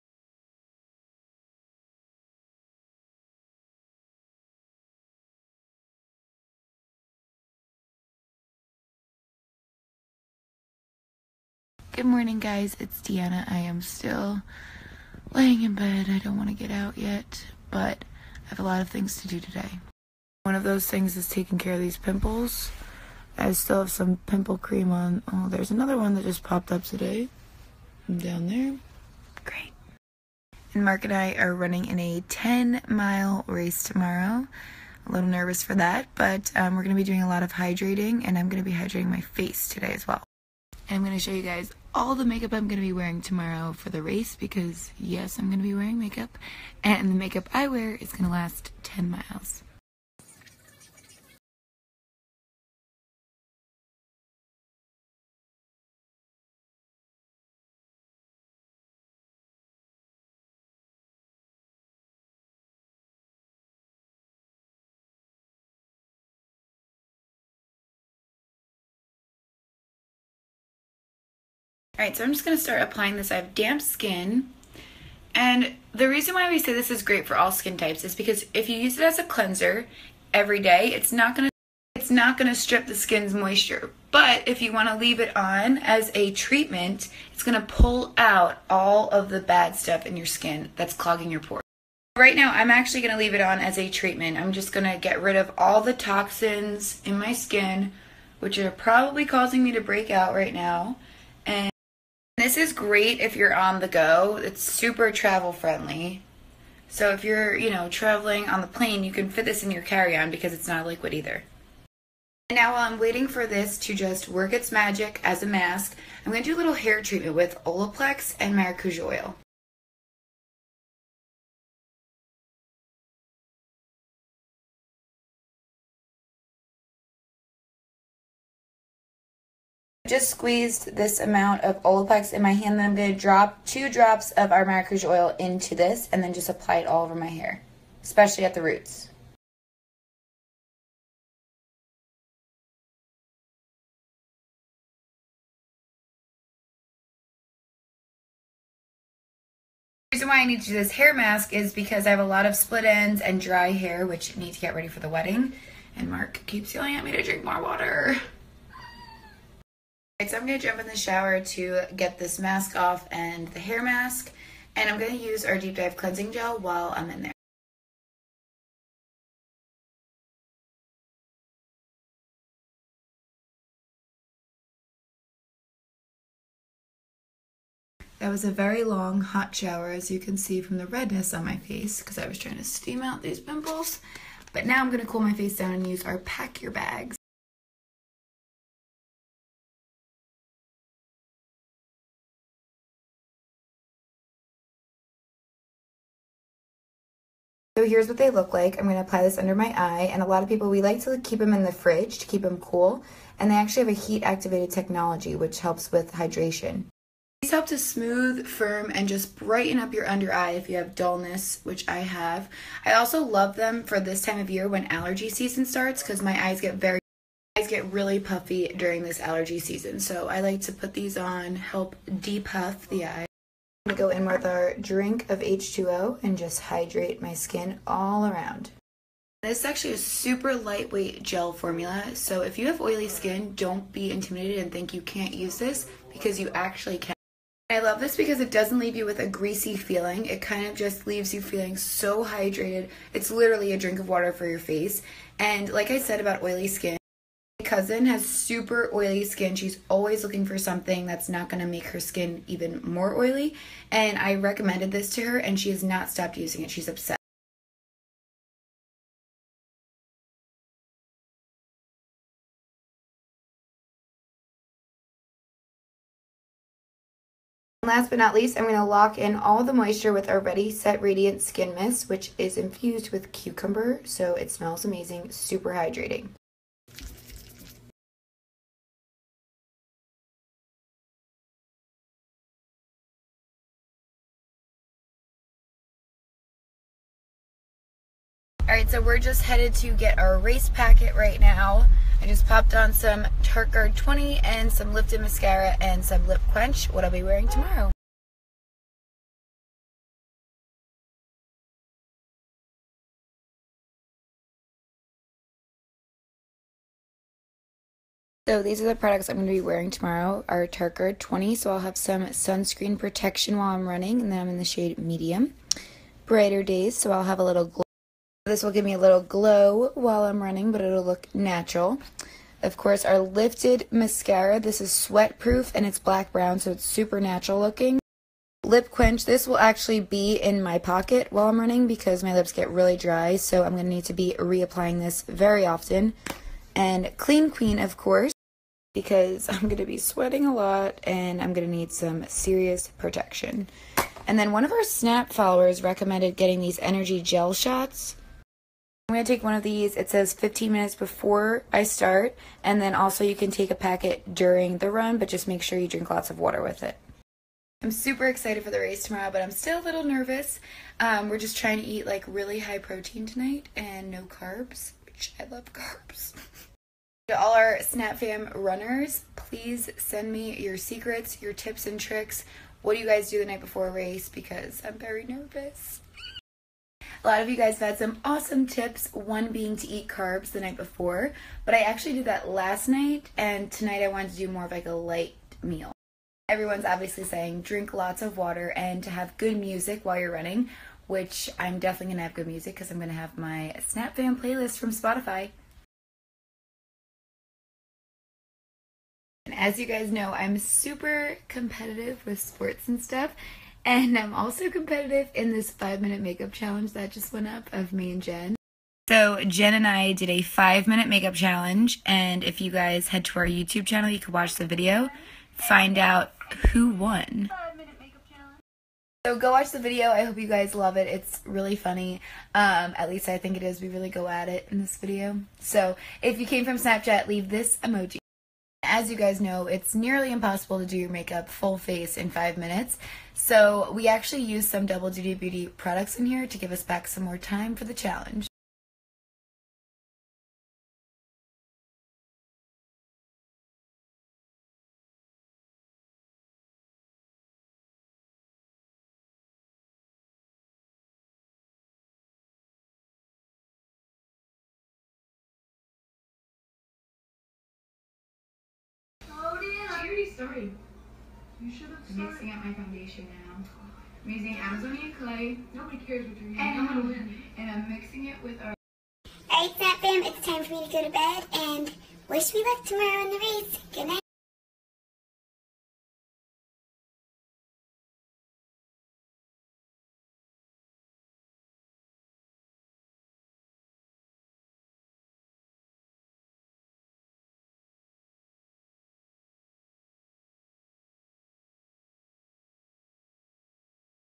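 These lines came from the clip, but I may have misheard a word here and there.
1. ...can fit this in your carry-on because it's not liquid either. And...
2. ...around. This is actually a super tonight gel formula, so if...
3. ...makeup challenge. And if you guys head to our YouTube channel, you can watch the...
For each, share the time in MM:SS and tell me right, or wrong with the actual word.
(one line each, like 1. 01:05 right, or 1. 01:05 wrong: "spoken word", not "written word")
1. 01:49 right
2. 03:48 wrong: "lightweight", not "tonight"
3. 06:51 right.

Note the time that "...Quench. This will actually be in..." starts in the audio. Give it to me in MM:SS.
05:28.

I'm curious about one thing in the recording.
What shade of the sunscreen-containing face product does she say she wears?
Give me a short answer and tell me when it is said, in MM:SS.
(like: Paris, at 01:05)
medium, at 05:14.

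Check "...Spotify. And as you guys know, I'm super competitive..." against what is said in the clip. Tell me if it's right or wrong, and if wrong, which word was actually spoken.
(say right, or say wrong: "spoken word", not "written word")
right.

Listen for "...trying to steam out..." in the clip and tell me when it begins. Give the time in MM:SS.
03:02.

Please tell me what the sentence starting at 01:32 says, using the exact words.
Right now, I'm actually gonna leave it on as a treatment.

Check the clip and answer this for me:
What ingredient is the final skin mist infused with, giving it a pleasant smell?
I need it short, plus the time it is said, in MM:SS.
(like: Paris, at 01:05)
cucumber, at 04:33.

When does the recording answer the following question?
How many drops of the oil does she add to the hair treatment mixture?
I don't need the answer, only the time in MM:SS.
02:13.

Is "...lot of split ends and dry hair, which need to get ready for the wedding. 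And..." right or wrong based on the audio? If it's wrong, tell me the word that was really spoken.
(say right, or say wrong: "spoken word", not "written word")
right.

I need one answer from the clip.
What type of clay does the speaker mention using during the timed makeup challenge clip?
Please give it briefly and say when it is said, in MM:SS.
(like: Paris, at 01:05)
Amazonian clay, at 07:44.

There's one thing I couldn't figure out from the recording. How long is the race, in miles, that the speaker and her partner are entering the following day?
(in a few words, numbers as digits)
10.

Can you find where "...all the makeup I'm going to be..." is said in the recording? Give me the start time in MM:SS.
00:41.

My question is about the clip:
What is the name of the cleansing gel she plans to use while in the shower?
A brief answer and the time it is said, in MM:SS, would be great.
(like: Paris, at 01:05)
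Deep Dive Cleansing Gel, at 02:45.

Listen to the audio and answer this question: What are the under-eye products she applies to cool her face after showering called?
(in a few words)
Pack Your Bags.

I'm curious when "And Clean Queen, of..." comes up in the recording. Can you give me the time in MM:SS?
05:36.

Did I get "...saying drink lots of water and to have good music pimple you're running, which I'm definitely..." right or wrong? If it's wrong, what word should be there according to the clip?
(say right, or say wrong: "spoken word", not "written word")
wrong: "while", not "pimple".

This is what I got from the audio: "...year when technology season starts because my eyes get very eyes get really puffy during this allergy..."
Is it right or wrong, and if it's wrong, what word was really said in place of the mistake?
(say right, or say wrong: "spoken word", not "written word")
wrong: "allergy", not "technology".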